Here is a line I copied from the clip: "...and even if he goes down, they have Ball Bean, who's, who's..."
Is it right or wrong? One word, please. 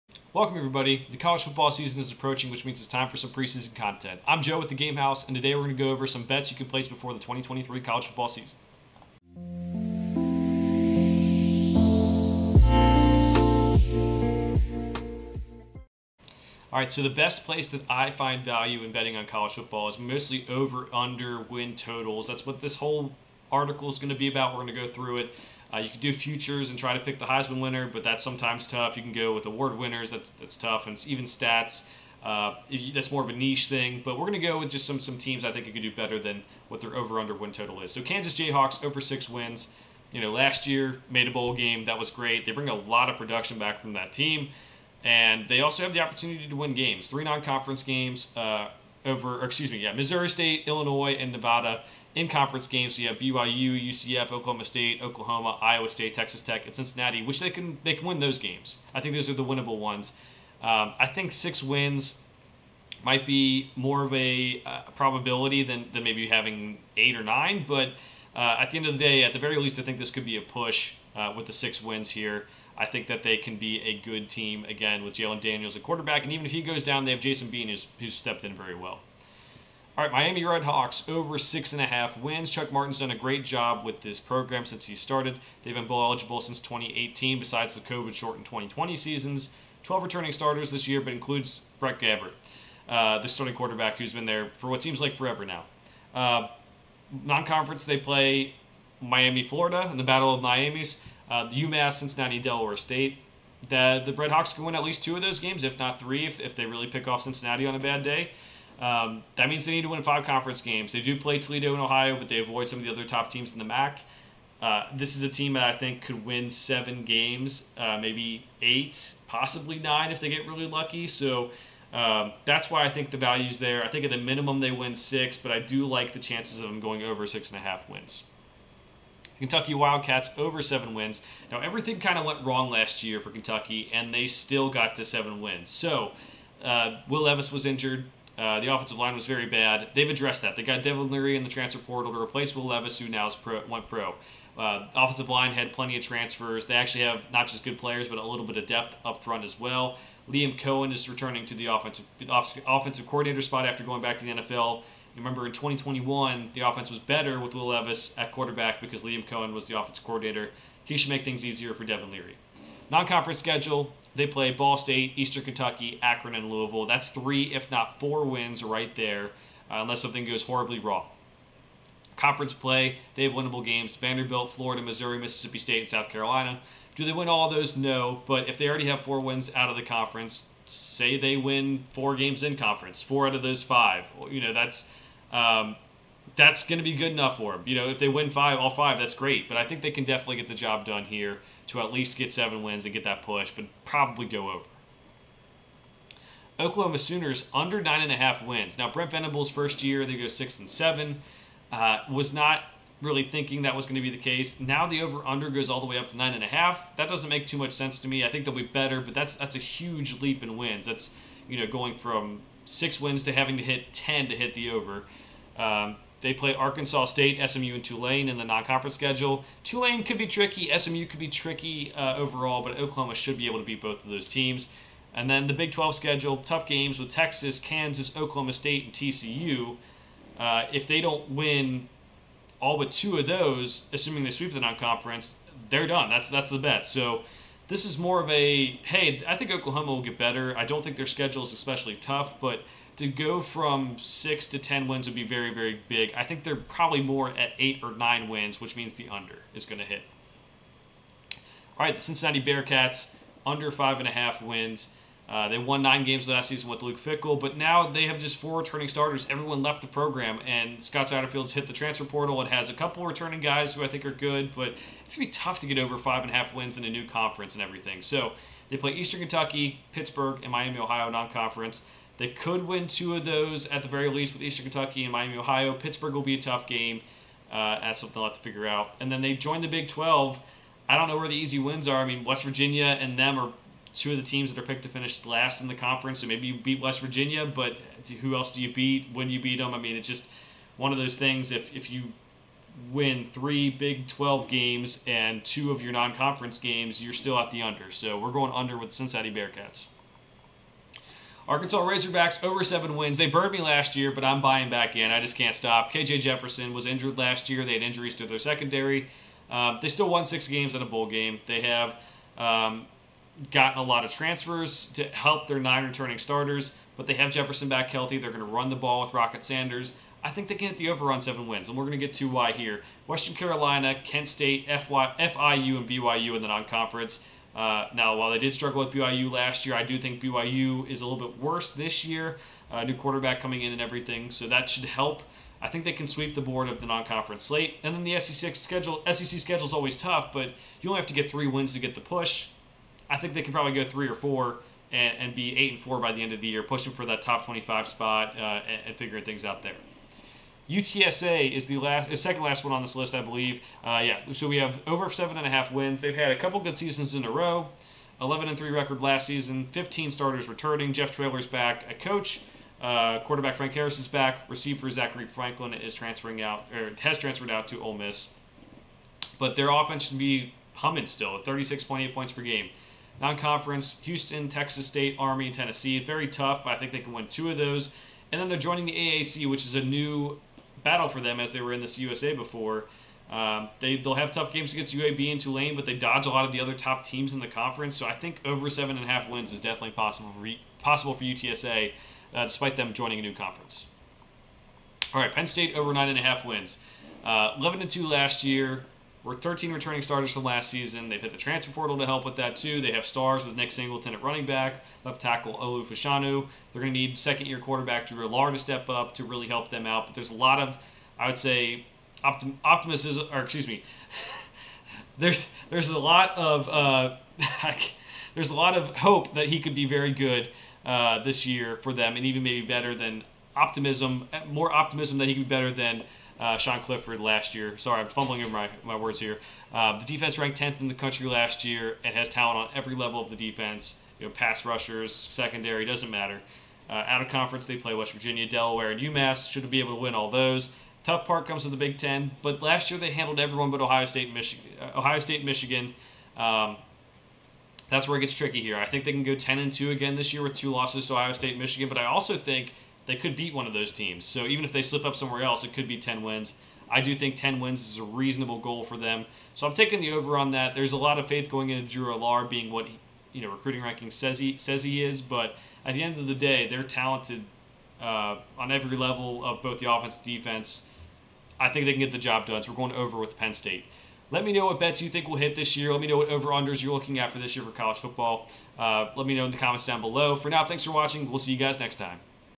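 wrong.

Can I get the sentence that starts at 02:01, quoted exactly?
So um, that's why I think the value's there.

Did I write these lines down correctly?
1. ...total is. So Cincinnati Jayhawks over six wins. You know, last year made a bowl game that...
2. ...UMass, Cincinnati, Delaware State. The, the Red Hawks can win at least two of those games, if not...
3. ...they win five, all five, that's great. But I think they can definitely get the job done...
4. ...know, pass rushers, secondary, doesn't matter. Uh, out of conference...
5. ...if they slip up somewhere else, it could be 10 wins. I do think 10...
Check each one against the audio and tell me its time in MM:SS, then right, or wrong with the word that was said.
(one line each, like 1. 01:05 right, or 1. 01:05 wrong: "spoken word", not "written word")
1. 00:37 wrong: "Kansas", not "Cincinnati"
2. 01:41 right
3. 03:07 right
4. 07:14 right
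5. 07:34 right.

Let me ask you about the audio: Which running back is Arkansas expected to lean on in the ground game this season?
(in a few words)
Rocket Sanders.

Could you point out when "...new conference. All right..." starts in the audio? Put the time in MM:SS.
06:33.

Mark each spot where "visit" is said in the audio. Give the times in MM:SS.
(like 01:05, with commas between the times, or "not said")
not said.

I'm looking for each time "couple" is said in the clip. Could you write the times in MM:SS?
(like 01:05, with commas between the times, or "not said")
04:22, 05:56.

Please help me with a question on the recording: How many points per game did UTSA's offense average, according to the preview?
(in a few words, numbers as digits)
36.8.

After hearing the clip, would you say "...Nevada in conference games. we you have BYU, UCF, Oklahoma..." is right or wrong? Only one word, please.
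right.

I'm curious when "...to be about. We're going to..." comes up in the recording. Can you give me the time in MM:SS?
00:24.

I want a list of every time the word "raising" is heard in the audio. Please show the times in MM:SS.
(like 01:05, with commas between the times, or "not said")
not said.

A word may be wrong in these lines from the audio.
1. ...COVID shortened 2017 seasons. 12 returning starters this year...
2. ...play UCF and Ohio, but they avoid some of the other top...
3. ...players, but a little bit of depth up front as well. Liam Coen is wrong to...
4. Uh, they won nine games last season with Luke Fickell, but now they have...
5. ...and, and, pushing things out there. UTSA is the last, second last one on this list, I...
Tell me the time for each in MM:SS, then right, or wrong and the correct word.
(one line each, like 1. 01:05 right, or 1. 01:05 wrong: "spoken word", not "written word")
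1. 01:27 wrong: "2020", not "2017"
2. 01:51 wrong: "Toledo", not "UCF"
3. 02:27 wrong: "returning", not "wrong"
4. 04:15 right
5. 05:48 wrong: "figuring", not "pushing".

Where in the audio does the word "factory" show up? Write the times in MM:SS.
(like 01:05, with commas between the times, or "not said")
not said.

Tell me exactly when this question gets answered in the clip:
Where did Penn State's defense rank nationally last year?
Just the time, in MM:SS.
07:10.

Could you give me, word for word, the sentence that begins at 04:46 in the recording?
So maybe you beat West Virginia, but who else do you beat?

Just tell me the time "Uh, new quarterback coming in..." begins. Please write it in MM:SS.
05:32.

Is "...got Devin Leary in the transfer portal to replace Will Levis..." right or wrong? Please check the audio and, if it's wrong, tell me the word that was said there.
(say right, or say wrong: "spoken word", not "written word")
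right.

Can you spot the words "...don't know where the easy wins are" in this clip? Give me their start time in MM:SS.
04:40.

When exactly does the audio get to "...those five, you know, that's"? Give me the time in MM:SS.
03:03.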